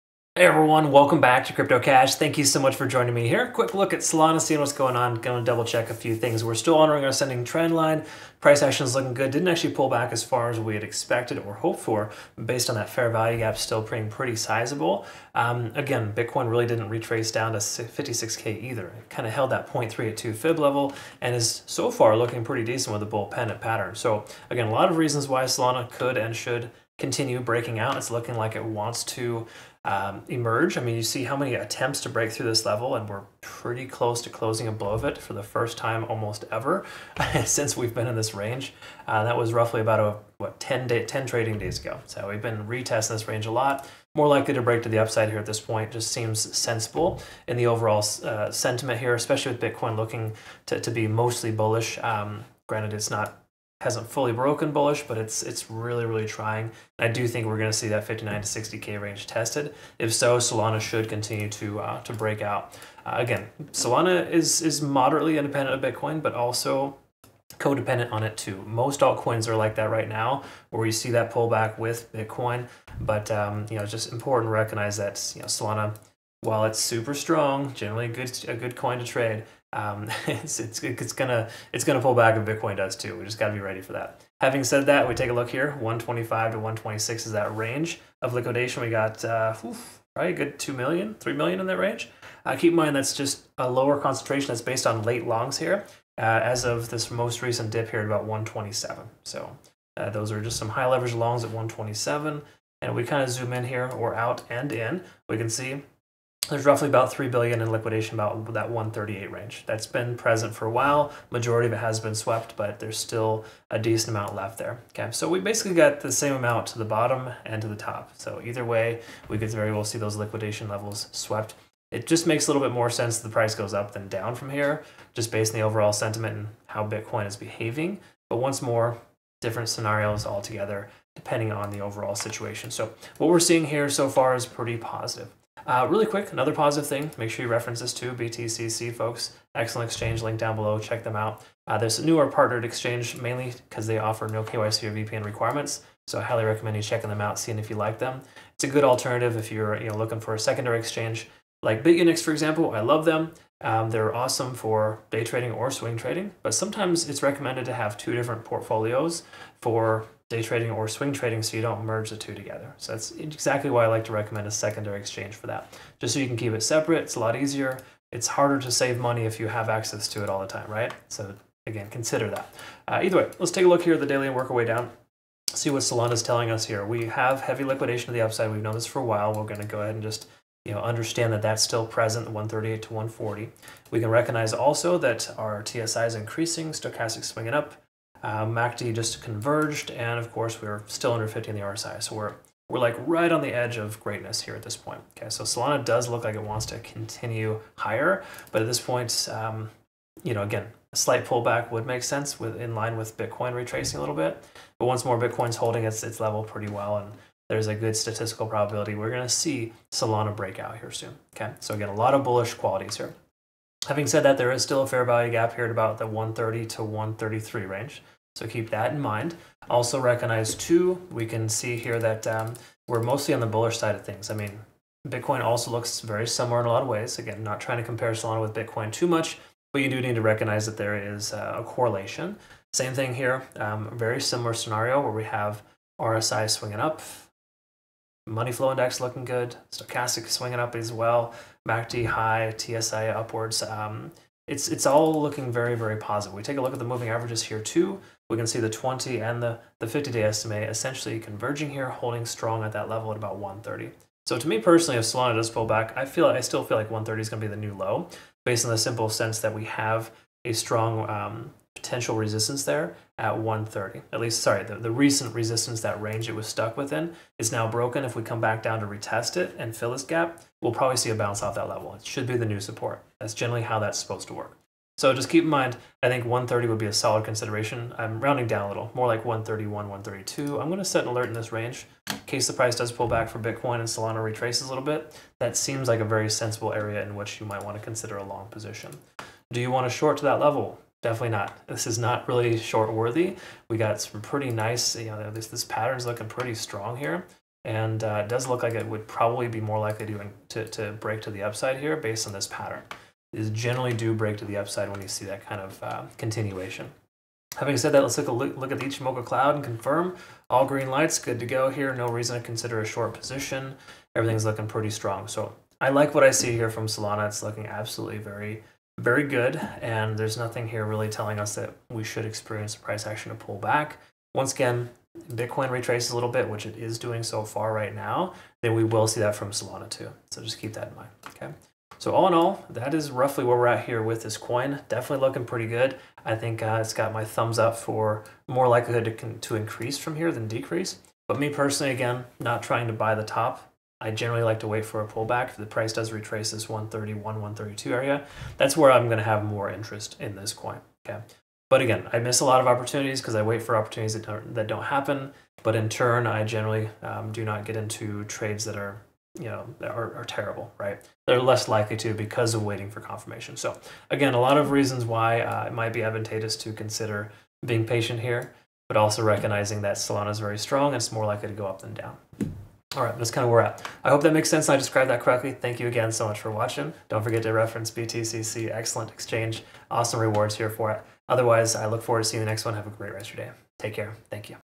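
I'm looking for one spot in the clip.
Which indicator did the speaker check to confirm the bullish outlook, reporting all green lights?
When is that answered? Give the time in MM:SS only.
05:08.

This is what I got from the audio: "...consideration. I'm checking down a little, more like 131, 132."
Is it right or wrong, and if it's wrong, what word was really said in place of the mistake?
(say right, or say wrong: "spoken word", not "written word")
wrong: "rounding", not "checking".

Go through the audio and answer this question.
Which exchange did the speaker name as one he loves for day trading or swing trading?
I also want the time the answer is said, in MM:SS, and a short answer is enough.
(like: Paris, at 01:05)
BitUnix, at 02:31.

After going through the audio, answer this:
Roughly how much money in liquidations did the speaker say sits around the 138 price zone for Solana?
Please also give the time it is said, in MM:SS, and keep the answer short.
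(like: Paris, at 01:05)
3 billion, at 01:47.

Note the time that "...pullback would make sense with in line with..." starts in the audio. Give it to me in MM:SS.
03:21.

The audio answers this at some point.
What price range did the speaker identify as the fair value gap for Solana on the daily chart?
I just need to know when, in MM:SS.
03:36.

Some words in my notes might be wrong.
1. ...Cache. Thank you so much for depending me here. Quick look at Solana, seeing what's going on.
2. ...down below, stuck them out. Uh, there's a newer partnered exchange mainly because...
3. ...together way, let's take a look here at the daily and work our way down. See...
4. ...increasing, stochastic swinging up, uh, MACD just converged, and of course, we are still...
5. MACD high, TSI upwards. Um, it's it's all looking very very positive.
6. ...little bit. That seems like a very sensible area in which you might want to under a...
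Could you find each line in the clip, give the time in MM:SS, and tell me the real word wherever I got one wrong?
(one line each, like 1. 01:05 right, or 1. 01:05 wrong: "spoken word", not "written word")
1. 00:01 wrong: "joining", not "depending"
2. 02:20 wrong: "check", not "stuck"
3. 02:53 wrong: "either", not "together"
4. 03:06 right
5. 04:01 right
6. 04:44 wrong: "consider", not "under".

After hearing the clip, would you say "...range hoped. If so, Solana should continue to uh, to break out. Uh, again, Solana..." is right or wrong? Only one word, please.
wrong.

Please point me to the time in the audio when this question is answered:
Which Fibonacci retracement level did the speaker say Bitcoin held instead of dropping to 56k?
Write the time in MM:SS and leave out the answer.
00:19.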